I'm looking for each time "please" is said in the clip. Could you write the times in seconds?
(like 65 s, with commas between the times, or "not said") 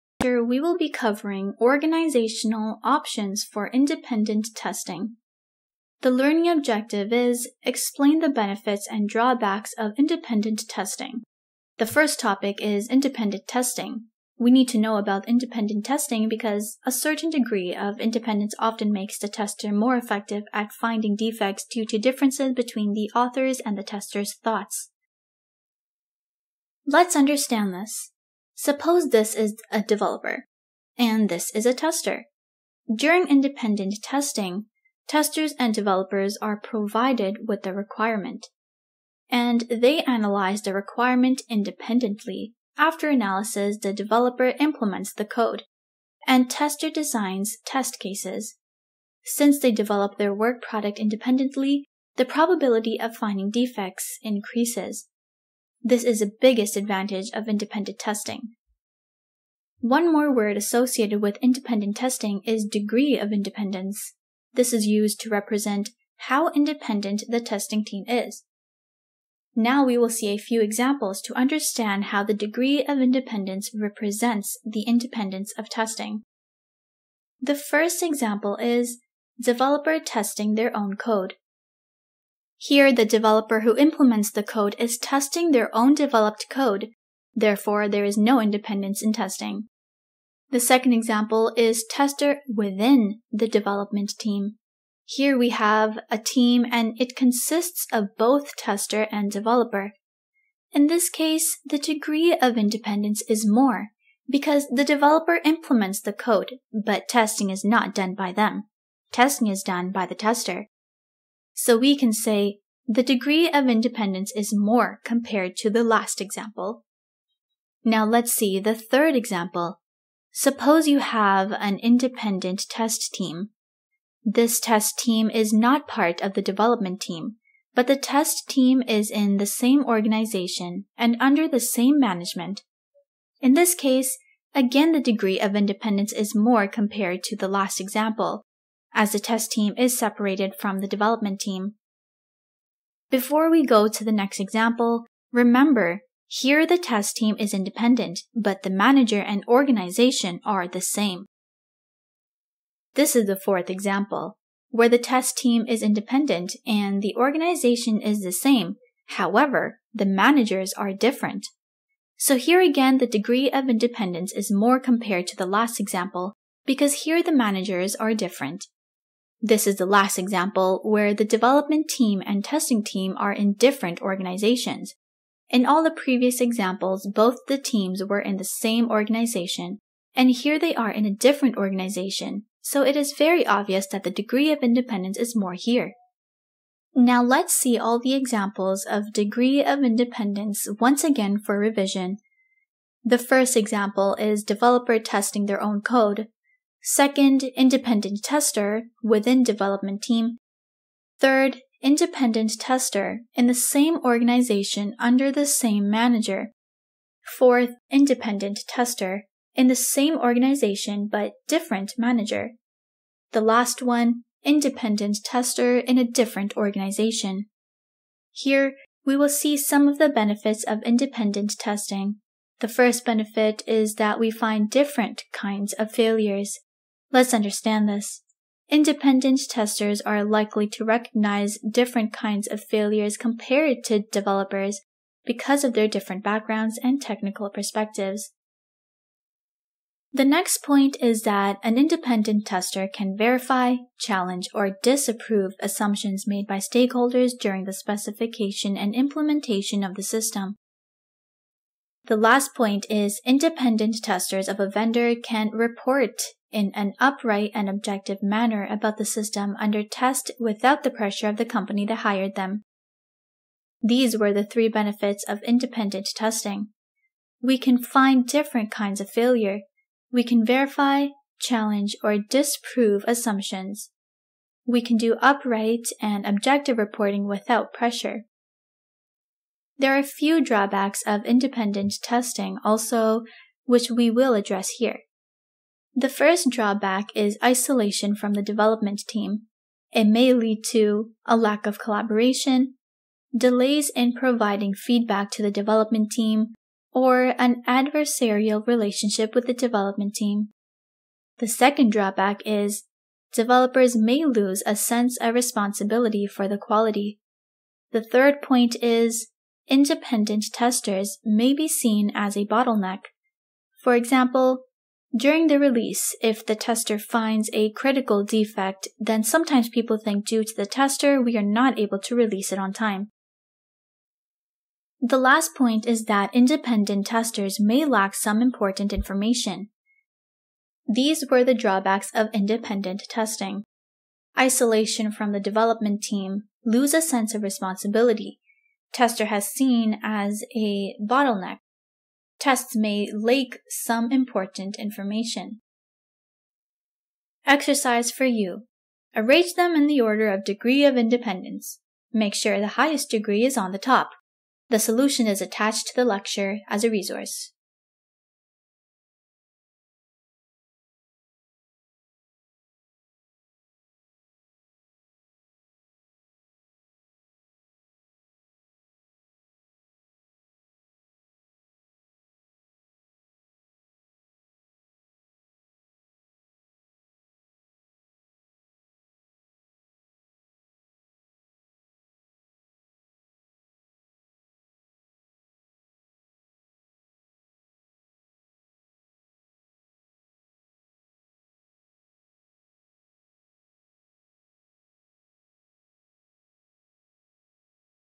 not said.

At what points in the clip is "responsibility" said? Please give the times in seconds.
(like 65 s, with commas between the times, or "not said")
305 s, 337 s.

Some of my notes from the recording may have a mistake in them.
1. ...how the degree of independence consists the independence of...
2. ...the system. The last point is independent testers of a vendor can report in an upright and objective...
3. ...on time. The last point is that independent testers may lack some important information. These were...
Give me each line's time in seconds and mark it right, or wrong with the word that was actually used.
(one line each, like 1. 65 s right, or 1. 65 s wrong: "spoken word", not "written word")
1. 72 s wrong: "represents", not "consists"
2. 249 s right
3. 322 s right.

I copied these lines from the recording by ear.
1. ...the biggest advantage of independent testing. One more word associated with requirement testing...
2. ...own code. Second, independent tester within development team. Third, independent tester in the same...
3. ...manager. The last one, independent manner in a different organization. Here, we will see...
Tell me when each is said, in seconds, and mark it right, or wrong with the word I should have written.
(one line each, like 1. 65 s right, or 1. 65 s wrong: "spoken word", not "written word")
1. 56 s wrong: "independent", not "requirement"
2. 195 s right
3. 211 s wrong: "tester", not "manner".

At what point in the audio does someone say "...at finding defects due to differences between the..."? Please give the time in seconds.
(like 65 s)
20 s.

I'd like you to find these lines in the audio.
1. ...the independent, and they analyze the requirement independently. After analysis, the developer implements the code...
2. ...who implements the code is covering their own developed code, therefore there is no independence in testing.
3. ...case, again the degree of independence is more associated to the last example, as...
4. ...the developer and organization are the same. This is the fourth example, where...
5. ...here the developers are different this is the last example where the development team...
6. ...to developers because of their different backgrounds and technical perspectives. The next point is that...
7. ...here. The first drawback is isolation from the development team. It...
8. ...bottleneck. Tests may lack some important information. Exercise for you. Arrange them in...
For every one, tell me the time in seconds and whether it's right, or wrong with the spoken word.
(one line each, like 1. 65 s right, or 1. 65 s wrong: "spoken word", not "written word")
1. 37 s wrong: "requirement", not "independent"
2. 83 s wrong: "testing", not "covering"
3. 133 s wrong: "compared", not "associated"
4. 148 s wrong: "manager", not "developer"
5. 167 s wrong: "managers", not "developers"
6. 233 s right
7. 284 s right
8. 340 s right.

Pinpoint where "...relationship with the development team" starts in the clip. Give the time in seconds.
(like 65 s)
298 s.